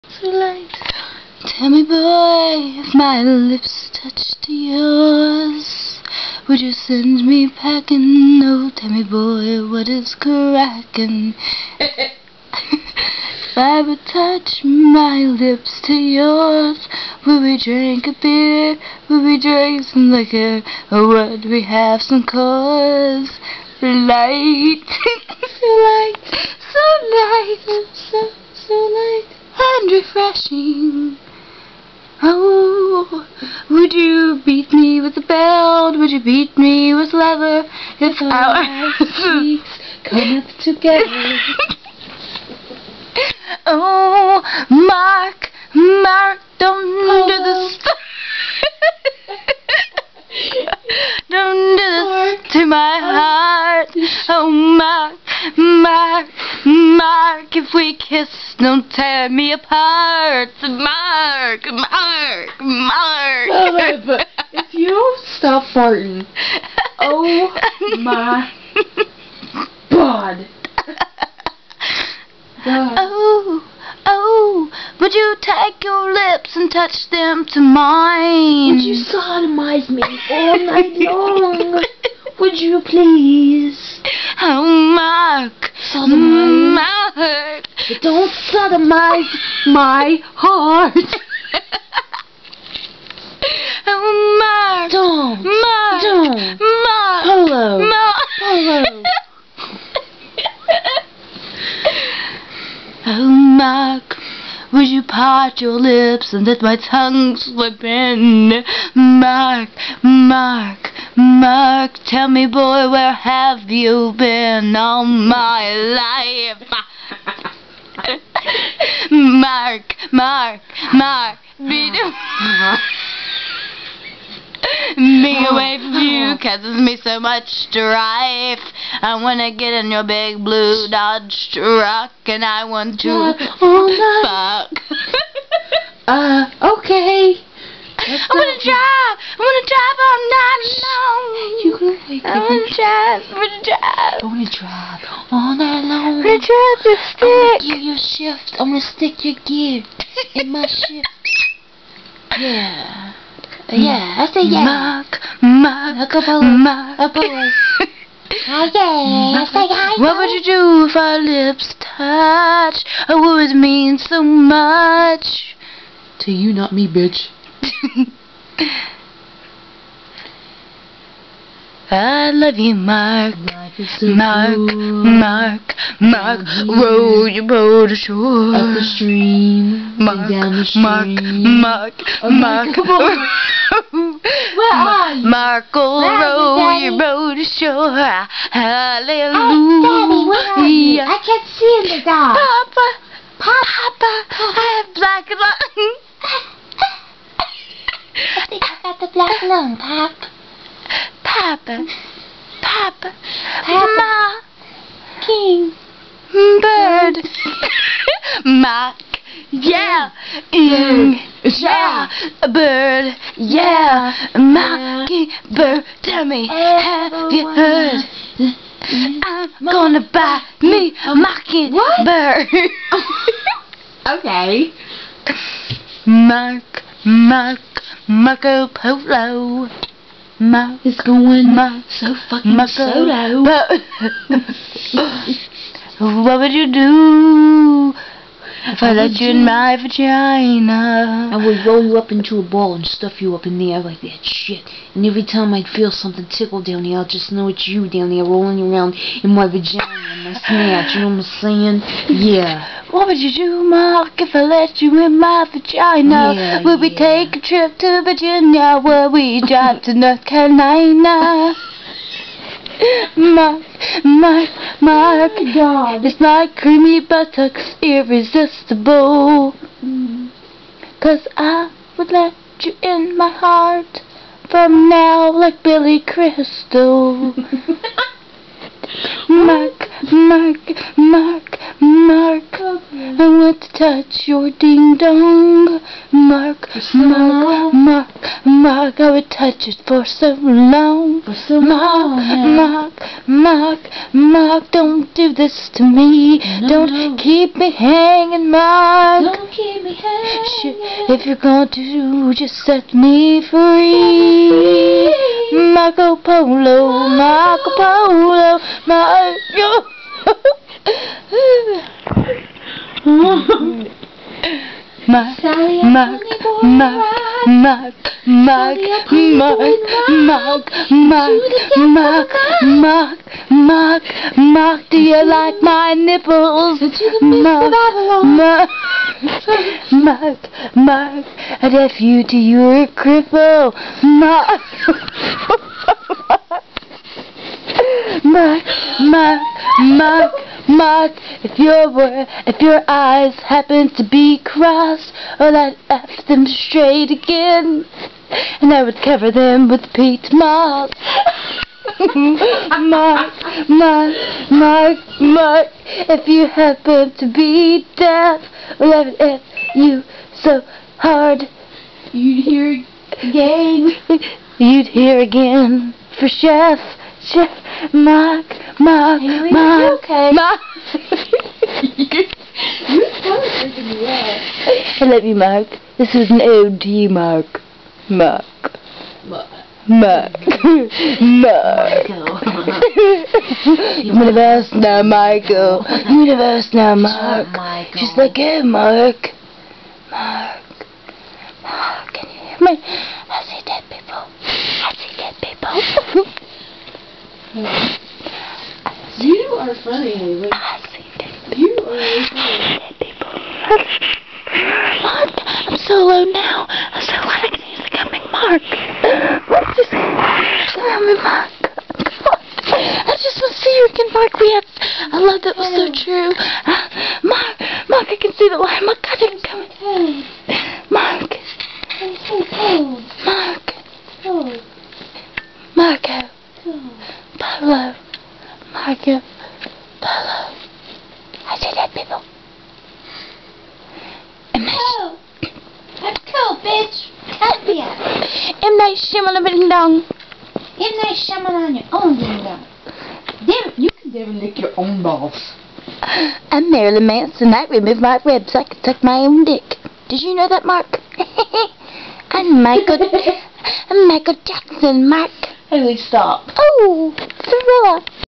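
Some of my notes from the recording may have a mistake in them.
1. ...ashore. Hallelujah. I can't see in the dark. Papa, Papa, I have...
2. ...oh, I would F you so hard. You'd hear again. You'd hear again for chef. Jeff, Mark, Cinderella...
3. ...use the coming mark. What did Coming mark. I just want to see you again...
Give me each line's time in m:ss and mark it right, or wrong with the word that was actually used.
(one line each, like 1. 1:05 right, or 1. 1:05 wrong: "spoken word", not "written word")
1. 3:07 right
2. 5:58 wrong: "Mark", not "Cinderella"
3. 6:47 right.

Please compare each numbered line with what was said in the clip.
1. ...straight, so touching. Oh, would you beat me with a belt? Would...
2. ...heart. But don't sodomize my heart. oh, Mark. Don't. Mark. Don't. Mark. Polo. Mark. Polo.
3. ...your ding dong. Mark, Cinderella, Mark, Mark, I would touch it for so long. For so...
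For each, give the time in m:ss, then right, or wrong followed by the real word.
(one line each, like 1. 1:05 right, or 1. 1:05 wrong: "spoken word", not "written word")
1. 0:27 wrong: "light", not "straight"
2. 1:27 right
3. 4:44 wrong: "Mark", not "Cinderella".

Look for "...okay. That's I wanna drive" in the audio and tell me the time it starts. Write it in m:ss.
2:16.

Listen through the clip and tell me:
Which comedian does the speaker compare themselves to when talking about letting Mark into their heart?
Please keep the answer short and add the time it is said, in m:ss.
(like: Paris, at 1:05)
Billy Crystal, at 4:35.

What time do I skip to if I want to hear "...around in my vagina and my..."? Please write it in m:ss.
4:08.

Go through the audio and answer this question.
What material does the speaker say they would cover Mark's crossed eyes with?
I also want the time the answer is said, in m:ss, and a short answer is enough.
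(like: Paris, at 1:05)
Peat moss, at 5:49.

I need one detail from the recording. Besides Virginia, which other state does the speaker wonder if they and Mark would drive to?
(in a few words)
North Carolina.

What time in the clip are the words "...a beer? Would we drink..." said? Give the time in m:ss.
0:18.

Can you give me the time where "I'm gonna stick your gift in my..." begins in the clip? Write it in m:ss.
2:28.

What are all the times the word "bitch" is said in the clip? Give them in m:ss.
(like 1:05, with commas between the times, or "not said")
2:46, 7:16.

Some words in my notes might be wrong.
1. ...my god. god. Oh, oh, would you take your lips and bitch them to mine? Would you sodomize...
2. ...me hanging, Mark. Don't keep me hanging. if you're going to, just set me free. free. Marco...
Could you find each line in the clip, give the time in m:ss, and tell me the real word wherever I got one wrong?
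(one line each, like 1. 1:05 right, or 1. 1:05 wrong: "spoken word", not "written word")
1. 1:08 wrong: "touch", not "bitch"
2. 4:57 right.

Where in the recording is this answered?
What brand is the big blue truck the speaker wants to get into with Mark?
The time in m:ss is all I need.
2:10.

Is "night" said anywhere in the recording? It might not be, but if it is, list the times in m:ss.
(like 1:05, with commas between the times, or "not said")
1:20, 2:20, 2:25.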